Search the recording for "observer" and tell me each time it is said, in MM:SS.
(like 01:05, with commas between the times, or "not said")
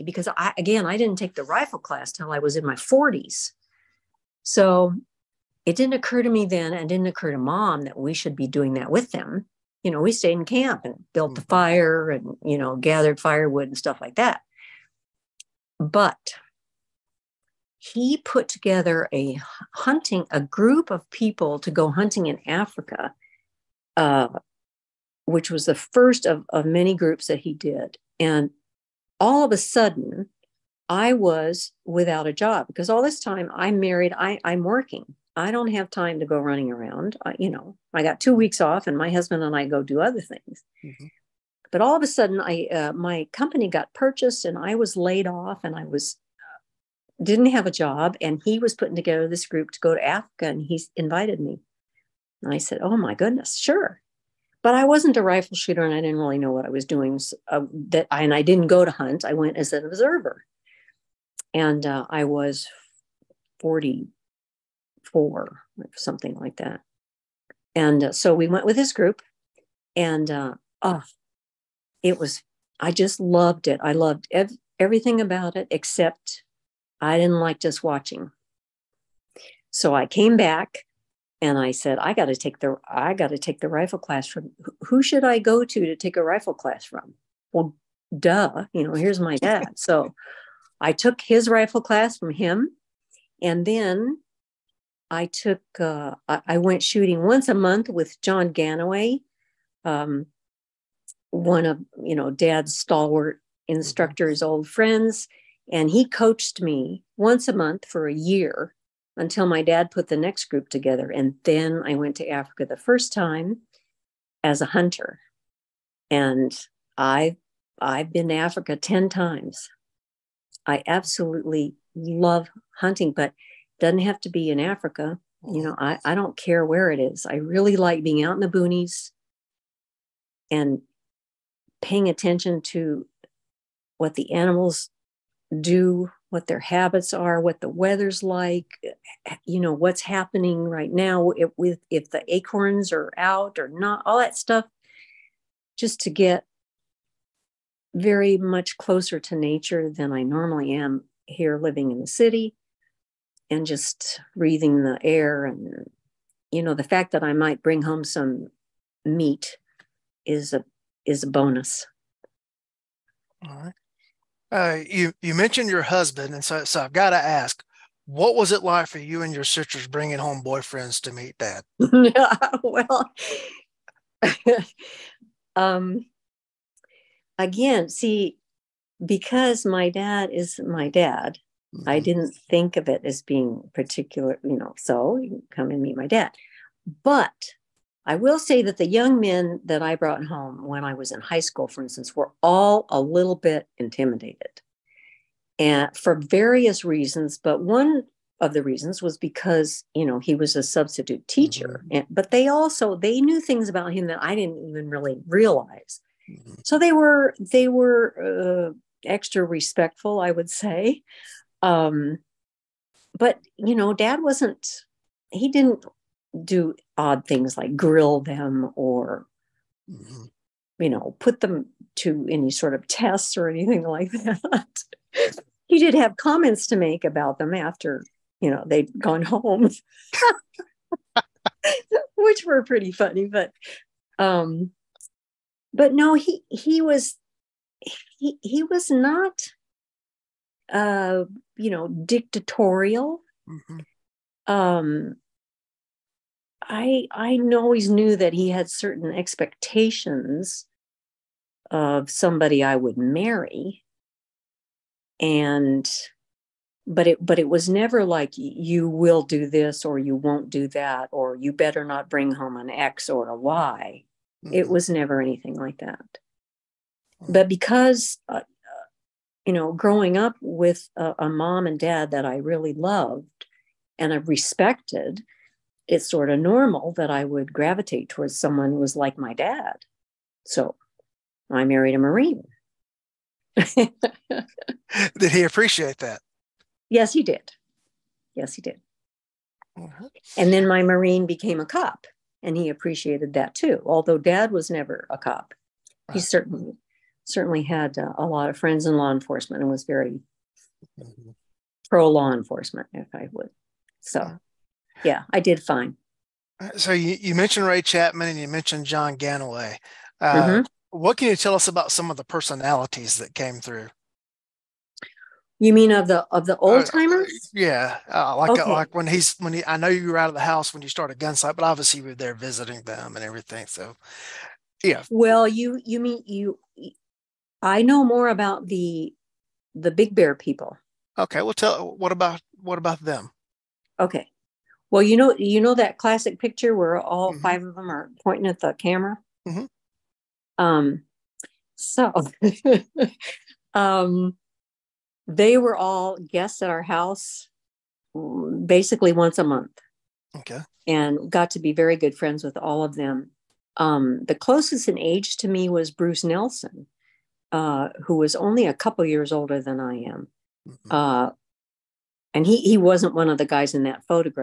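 00:59.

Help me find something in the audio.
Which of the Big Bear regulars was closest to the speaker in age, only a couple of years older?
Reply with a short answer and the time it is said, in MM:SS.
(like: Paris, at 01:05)
Bruce Nelson, at 05:55.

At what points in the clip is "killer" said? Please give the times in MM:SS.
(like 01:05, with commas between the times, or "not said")
not said.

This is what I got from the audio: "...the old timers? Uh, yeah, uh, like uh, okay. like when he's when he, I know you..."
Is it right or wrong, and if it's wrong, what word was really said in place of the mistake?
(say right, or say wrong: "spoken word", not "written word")
right.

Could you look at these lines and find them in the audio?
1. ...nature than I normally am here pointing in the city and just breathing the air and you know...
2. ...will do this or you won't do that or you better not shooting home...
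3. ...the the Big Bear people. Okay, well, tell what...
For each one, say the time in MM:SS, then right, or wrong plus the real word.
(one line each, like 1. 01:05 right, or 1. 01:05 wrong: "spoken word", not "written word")
1. 02:29 wrong: "living", not "pointing"
2. 04:18 wrong: "bring", not "shooting"
3. 05:28 right.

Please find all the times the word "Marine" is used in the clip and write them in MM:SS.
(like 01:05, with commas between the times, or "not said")
04:41, 04:50.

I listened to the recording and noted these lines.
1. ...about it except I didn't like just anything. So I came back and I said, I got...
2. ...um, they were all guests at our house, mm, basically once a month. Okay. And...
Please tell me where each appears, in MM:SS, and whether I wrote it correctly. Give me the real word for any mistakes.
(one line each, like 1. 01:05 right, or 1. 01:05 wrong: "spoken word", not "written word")
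1. 01:15 wrong: "watching", not "anything"
2. 05:43 right.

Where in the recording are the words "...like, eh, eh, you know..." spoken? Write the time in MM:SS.
02:18.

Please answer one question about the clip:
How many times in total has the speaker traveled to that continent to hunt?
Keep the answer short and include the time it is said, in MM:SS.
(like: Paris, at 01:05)
10, at 01:58.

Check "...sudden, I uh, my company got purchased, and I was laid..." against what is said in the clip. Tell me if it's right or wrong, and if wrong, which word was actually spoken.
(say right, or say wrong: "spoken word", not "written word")
right.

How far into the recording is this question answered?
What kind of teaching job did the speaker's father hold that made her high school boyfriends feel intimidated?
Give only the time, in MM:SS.
03:20.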